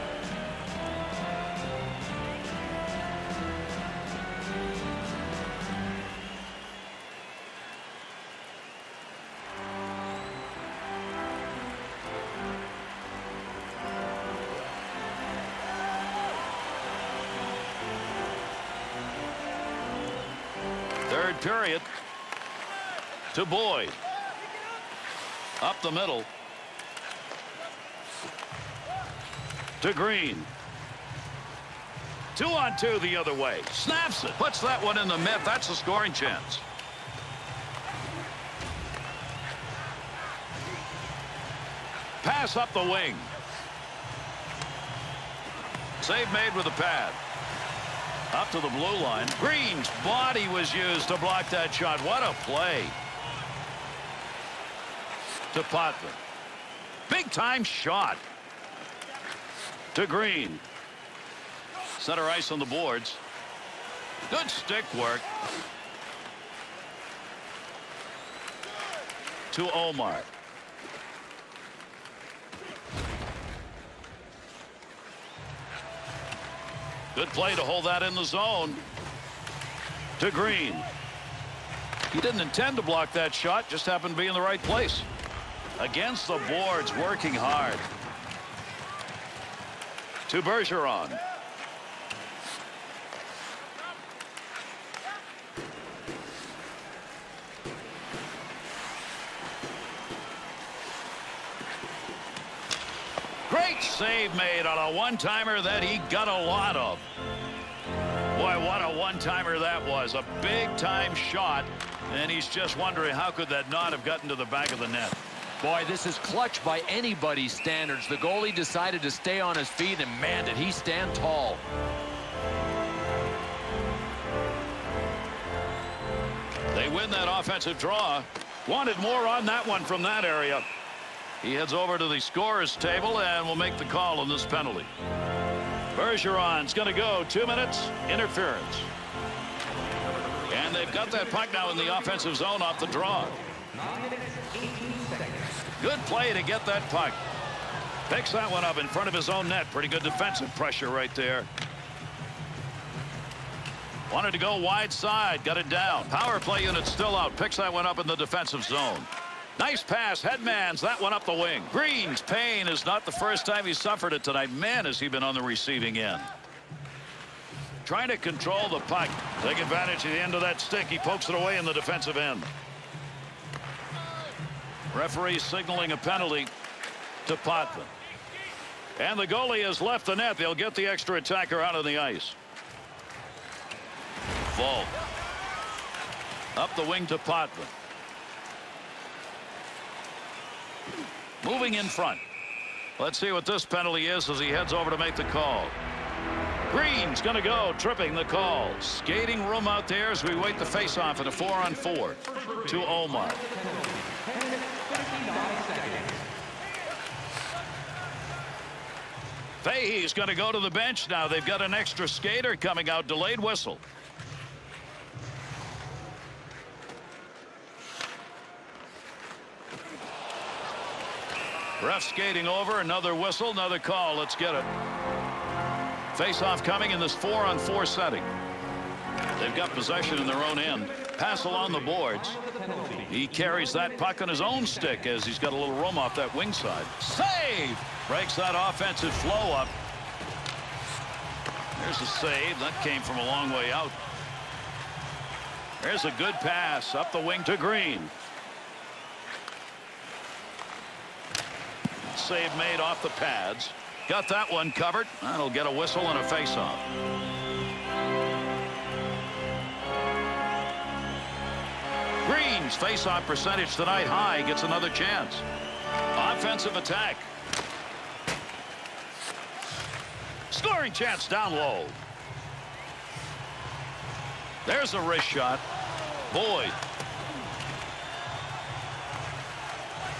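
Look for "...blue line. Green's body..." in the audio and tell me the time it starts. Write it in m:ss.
0:48.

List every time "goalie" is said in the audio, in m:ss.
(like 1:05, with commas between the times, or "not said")
1:58, 2:59.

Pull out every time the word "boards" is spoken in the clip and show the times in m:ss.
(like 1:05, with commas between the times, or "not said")
1:02, 1:26, 3:51.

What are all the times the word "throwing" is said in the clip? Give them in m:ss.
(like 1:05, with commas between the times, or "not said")
not said.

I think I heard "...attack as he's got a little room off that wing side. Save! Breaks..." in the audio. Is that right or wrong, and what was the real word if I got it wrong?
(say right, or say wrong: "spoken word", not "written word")
wrong: "stick", not "attack".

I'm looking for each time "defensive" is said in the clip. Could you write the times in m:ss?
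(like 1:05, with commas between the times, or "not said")
2:30, 2:38, 2:51.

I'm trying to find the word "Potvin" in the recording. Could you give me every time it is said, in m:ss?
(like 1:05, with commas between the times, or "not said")
0:55, 2:57, 3:07.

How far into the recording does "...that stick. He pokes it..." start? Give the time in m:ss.
2:50.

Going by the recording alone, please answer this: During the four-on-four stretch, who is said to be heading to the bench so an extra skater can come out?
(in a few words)
Fahey.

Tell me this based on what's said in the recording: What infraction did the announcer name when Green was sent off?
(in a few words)
Tripping.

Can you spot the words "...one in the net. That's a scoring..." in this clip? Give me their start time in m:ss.
0:34.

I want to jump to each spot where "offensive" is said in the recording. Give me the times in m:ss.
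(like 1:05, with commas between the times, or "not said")
2:07, 2:21, 3:58, 4:26.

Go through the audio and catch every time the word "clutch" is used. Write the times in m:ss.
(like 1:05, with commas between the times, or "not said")
1:56.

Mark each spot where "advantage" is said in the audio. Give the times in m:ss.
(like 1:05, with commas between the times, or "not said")
2:49.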